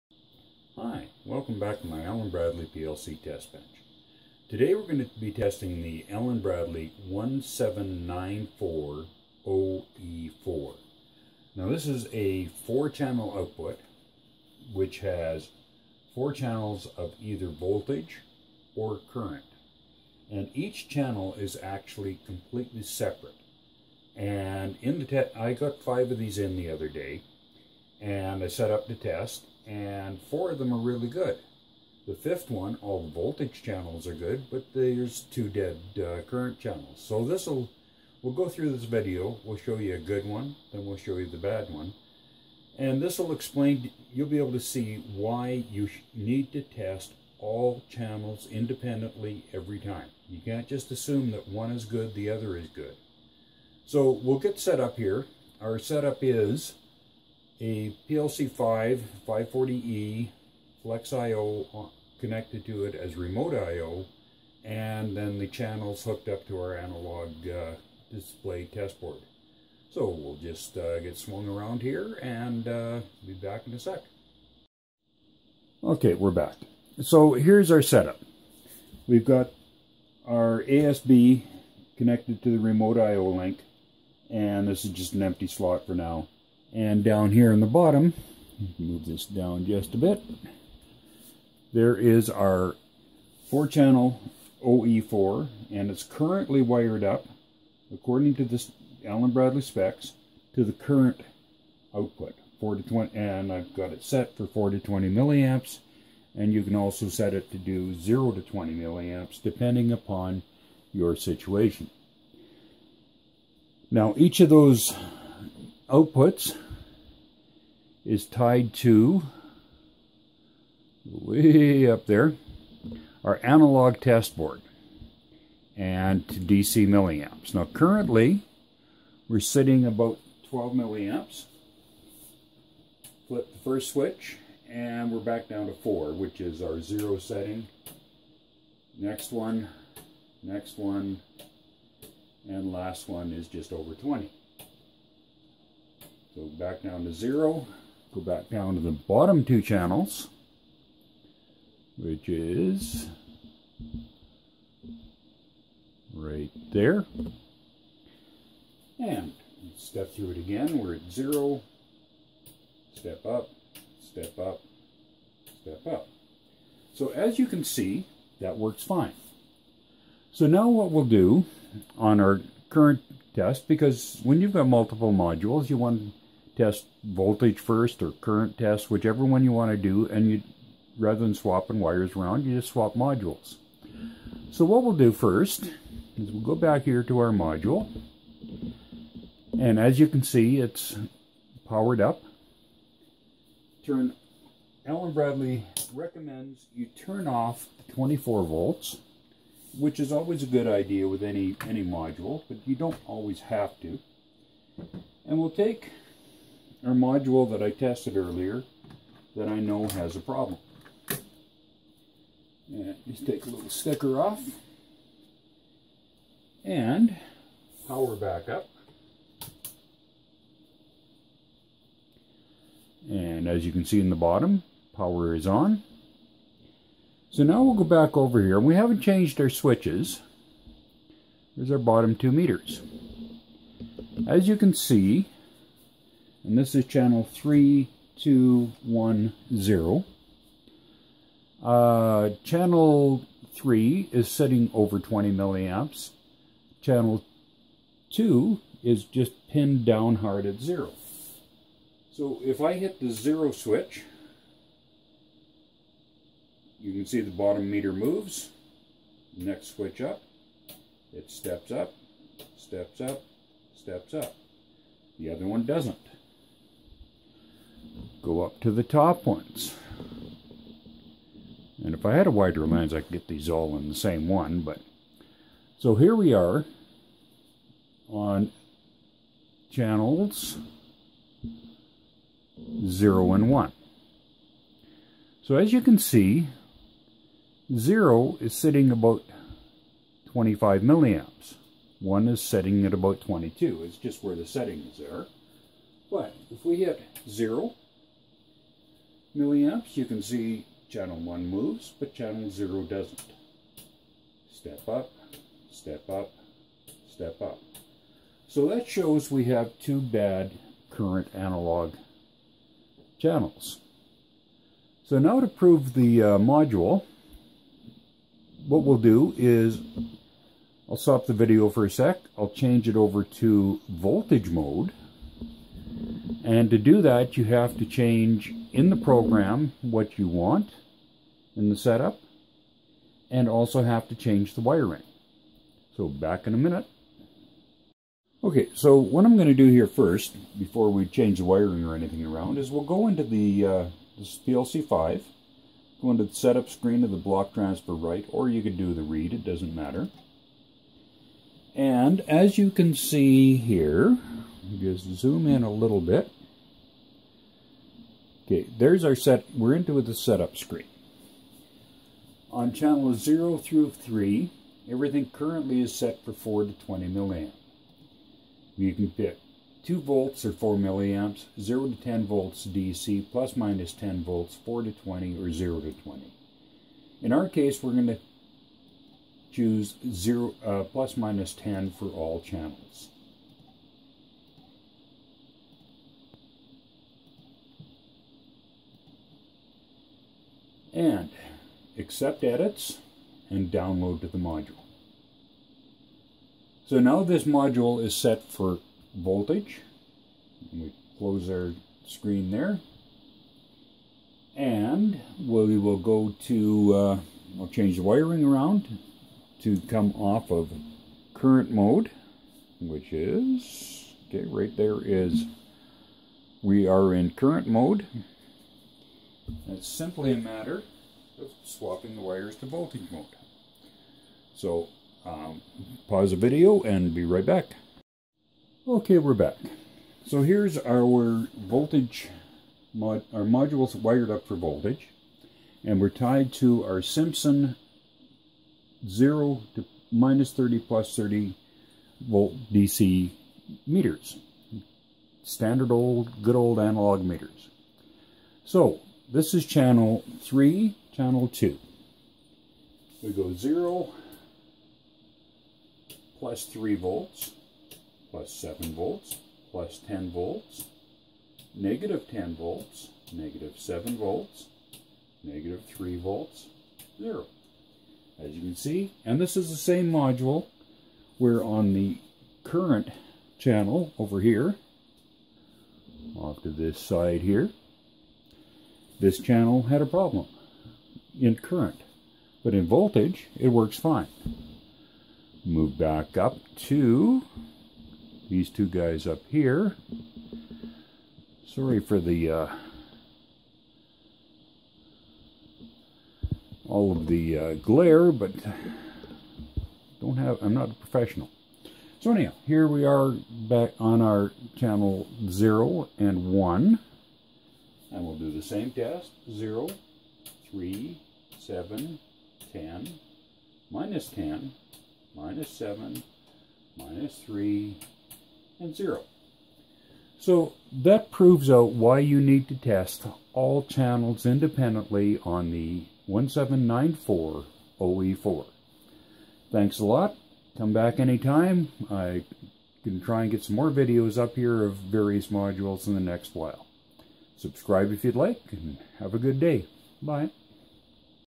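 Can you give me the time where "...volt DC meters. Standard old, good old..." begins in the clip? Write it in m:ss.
7:22.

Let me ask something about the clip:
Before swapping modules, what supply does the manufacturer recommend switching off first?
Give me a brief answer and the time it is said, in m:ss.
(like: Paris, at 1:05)
24 volts, at 3:17.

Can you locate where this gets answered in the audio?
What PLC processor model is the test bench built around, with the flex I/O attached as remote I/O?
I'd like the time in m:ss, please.
0:58.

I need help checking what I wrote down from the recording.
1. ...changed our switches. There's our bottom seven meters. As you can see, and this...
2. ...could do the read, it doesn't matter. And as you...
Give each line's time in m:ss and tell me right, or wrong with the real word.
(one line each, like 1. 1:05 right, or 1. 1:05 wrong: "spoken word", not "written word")
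1. 3:49 wrong: "two", not "seven"
2. 5:48 right.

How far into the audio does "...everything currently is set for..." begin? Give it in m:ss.
6:04.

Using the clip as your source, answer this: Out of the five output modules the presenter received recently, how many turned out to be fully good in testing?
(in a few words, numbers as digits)
4.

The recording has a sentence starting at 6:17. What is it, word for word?
In our case, we're going to choose zero, uh, plus minus 10 for all channels.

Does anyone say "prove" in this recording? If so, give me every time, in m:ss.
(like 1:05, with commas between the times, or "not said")
5:15, 8:41.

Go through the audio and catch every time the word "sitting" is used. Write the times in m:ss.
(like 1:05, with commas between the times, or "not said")
2:09, 4:04, 4:48.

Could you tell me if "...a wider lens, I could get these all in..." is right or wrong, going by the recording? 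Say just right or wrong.
right.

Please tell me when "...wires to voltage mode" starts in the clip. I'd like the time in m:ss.
7:02.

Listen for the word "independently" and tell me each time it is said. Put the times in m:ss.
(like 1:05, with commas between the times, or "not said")
0:48, 8:44.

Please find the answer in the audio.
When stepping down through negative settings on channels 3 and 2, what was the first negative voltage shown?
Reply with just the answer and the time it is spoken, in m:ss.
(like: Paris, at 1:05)
-10 volts, at 7:41.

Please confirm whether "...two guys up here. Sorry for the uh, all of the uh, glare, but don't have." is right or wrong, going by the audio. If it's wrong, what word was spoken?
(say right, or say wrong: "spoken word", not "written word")
right.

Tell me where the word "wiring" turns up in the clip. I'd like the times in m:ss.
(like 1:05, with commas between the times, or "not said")
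5:34, 5:41, 6:48.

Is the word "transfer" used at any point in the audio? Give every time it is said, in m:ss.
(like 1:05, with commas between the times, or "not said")
5:47.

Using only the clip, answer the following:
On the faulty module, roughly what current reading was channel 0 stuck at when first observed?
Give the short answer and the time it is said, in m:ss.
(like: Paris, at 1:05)
25 milliamps, at 4:50.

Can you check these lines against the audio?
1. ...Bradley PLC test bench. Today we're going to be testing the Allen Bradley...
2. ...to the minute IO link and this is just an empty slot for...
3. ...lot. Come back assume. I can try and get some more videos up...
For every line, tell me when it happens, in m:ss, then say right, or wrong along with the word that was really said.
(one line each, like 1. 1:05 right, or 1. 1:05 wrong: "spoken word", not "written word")
1. 0:02 right
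2. 1:22 wrong: "remote", not "minute"
3. 8:50 wrong: "anytime", not "assume".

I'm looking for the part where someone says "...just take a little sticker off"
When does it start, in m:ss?
3:33.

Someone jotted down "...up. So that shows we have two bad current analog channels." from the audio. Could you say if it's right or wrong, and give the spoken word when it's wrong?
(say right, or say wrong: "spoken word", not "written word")
right.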